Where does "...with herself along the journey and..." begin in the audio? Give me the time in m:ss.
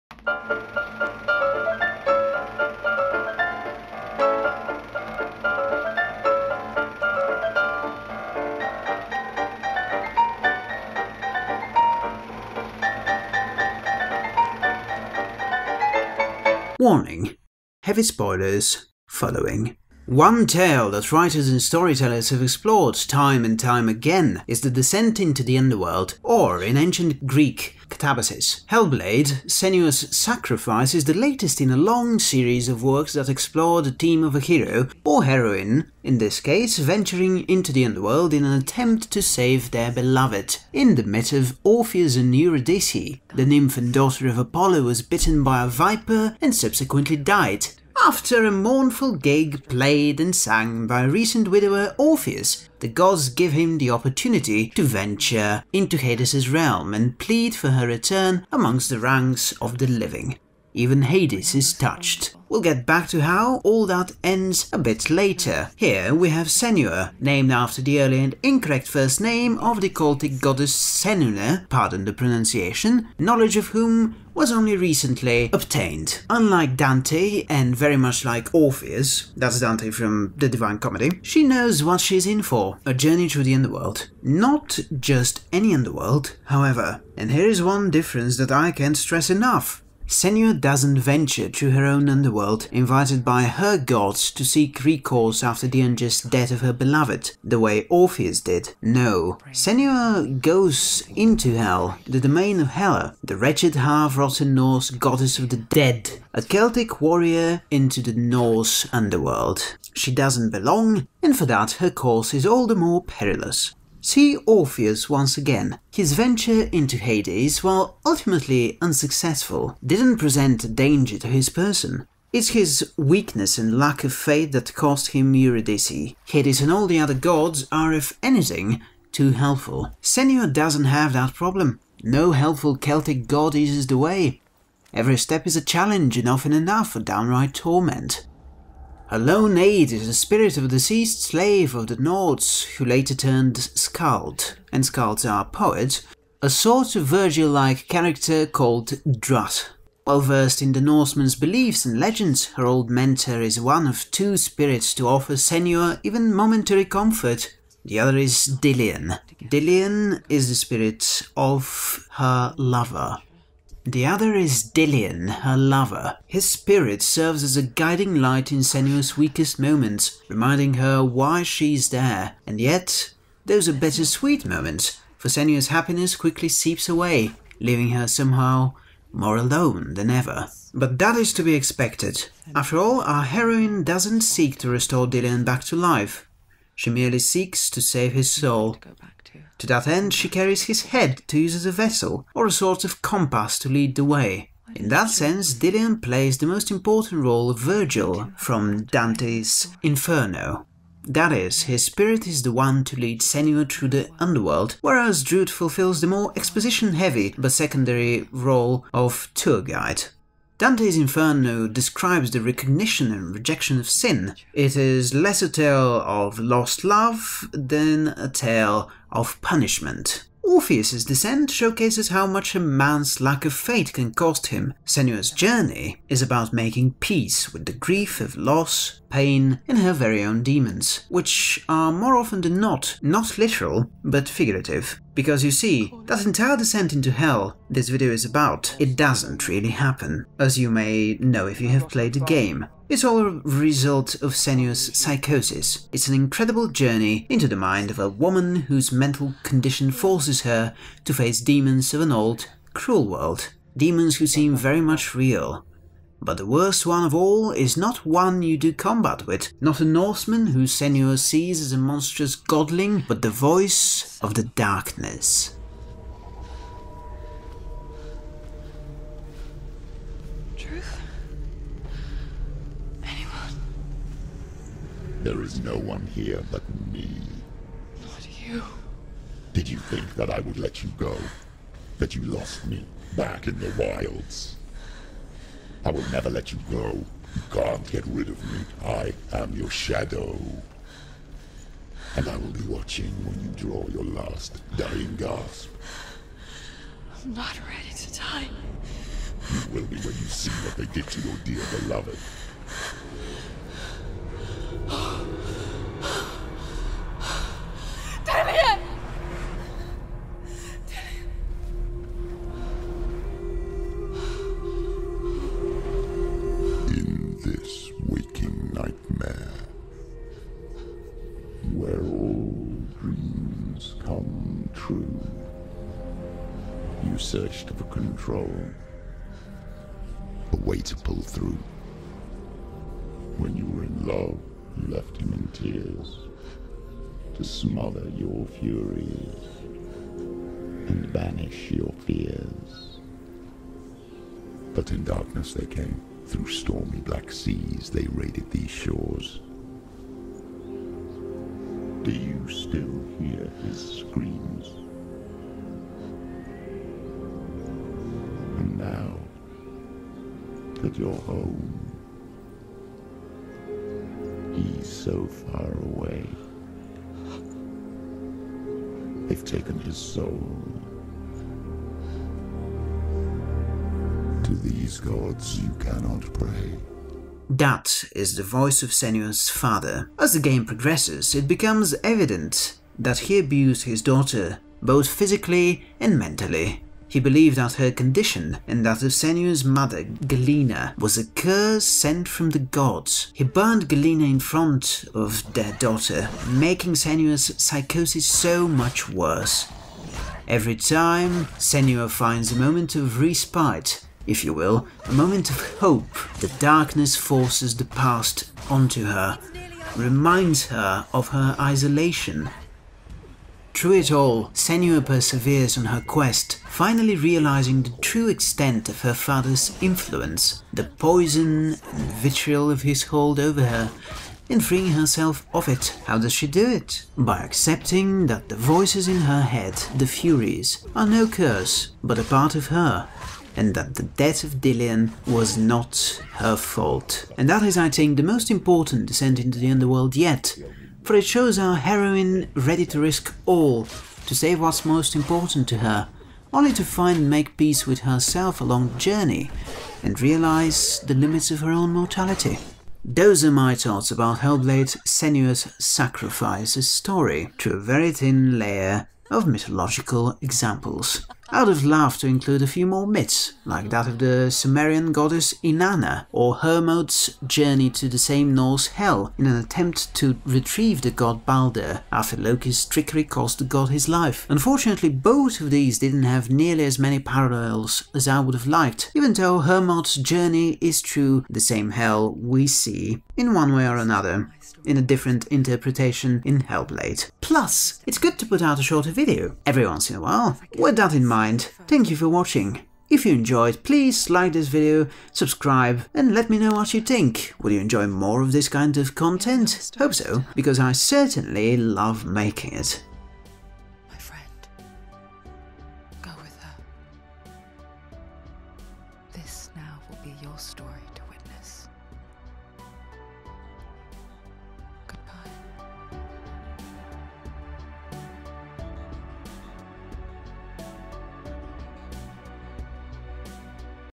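7:27.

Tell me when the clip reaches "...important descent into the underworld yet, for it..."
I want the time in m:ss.
7:18.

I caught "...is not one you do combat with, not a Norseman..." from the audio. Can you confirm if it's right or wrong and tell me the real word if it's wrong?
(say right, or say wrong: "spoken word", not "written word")
right.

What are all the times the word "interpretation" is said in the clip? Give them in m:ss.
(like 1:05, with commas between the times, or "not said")
8:05.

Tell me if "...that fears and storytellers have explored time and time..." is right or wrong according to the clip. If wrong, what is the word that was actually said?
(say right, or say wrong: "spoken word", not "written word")
wrong: "writers", not "fears".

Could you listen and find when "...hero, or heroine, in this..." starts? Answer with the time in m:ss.
0:34.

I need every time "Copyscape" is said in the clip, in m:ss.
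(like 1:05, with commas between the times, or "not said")
not said.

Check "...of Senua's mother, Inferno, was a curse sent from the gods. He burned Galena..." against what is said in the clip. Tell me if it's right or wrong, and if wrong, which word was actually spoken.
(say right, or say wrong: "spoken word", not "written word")
wrong: "Galena", not "Inferno".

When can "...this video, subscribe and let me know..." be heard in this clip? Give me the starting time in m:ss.
8:14.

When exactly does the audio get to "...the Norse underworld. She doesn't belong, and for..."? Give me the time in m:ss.
1:48.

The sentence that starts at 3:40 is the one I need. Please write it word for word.
Orpheus's descent showcases how much a man's lack of faith can cost him.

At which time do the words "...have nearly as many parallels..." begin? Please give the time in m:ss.
7:56.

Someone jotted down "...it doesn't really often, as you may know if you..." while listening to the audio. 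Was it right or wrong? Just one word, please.
wrong.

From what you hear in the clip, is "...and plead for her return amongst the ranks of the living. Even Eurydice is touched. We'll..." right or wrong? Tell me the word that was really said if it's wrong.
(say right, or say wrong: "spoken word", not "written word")
wrong: "Hades", not "Eurydice".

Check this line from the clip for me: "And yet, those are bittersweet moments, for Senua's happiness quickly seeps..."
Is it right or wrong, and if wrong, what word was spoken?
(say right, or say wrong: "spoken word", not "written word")
right.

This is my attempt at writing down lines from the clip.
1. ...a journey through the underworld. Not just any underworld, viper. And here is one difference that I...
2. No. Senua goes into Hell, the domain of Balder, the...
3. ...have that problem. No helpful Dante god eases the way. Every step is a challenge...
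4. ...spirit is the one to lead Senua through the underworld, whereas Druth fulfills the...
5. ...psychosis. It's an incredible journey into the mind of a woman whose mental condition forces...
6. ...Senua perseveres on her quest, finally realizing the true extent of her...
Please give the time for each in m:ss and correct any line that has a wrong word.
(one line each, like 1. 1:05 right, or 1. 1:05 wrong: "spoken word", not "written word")
1. 1:22 wrong: "however", not "viper"
2. 1:38 wrong: "Hela", not "Balder"
3. 2:10 wrong: "Celtic", not "Dante"
4. 3:21 right
5. 4:04 right
6. 6:54 right.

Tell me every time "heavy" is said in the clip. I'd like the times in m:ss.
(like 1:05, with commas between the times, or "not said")
0:17, 3:26.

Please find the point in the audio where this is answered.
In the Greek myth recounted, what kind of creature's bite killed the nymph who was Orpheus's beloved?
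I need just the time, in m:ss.
0:45.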